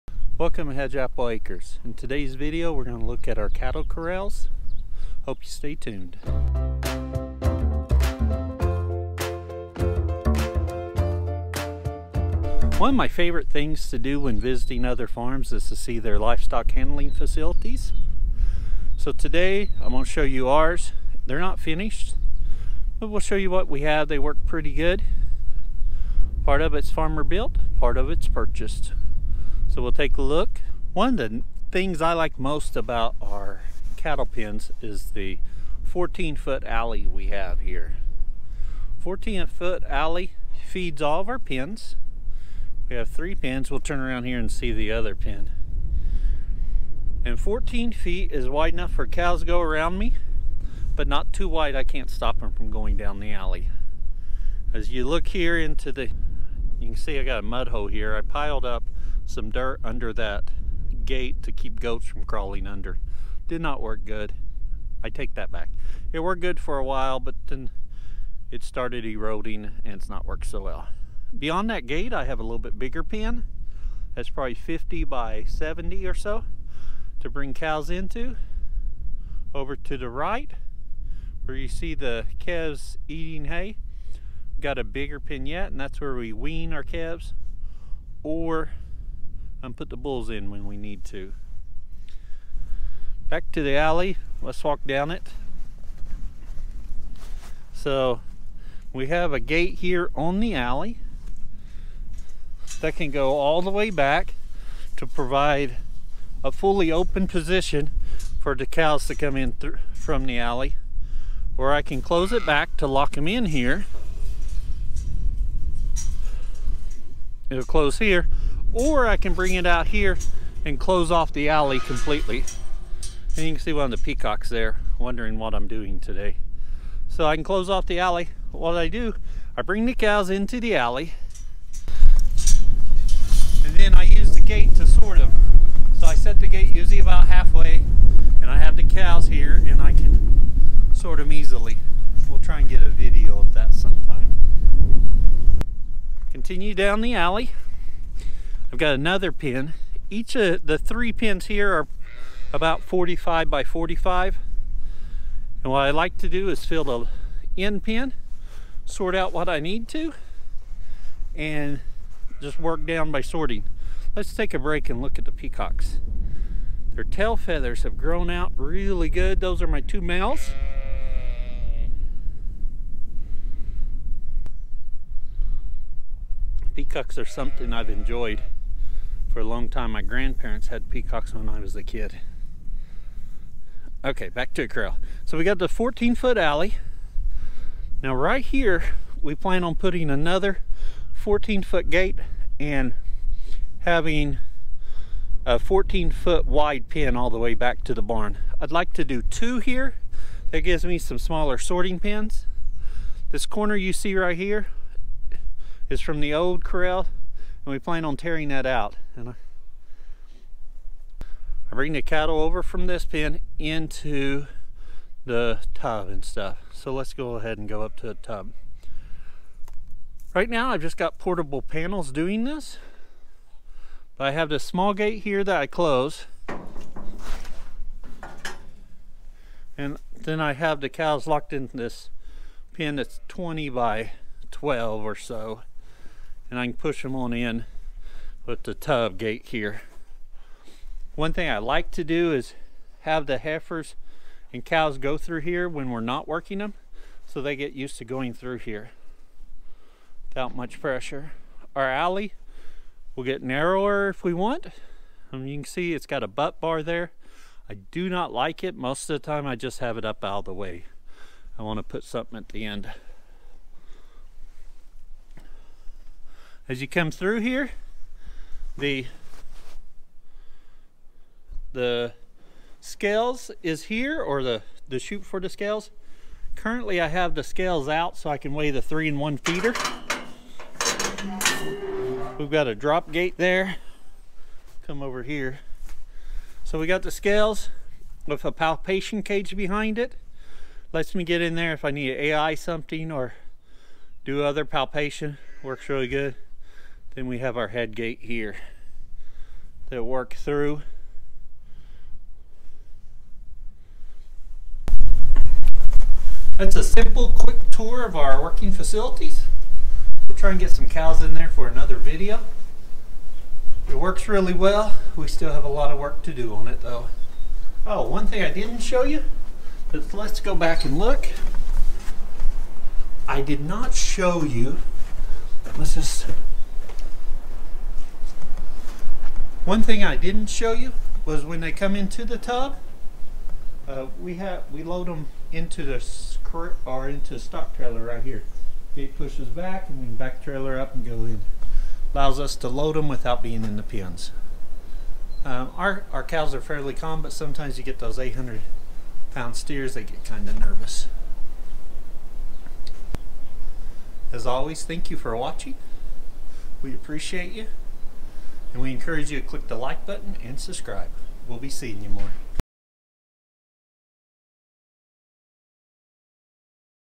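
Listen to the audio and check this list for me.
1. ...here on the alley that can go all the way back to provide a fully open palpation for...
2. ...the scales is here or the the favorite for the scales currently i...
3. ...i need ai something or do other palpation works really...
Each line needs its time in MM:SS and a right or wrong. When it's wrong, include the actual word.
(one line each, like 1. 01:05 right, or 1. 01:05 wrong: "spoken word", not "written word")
1. 01:39 wrong: "position", not "palpation"
2. 04:31 wrong: "chute", not "favorite"
3. 04:51 right.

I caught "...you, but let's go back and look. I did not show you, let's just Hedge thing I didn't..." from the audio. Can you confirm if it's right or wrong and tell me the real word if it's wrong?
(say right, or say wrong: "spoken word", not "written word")
wrong: "One", not "Hedge".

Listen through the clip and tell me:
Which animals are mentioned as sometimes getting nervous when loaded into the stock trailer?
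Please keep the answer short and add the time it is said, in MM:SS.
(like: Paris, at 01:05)
800 pound steers, at 05:48.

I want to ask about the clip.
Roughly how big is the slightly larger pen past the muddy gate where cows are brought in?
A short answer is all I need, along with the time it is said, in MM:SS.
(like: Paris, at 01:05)
50 by 70, at 01:14.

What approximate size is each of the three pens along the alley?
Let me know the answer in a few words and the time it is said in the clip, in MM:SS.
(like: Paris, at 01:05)
45 by 45, at 02:32.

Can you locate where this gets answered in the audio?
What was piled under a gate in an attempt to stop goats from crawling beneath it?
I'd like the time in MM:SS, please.
00:59.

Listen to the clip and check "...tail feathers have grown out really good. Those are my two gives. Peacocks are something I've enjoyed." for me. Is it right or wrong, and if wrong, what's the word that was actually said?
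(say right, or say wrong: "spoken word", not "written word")
wrong: "males", not "gives".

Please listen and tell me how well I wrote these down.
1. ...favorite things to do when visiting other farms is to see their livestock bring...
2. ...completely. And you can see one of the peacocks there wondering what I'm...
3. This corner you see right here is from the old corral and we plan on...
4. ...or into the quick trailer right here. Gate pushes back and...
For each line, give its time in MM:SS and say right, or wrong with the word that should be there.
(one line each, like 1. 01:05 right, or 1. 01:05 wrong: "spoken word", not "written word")
1. 00:13 wrong: "handling", not "bring"
2. 02:01 right
3. 03:23 right
4. 05:36 wrong: "stock", not "quick".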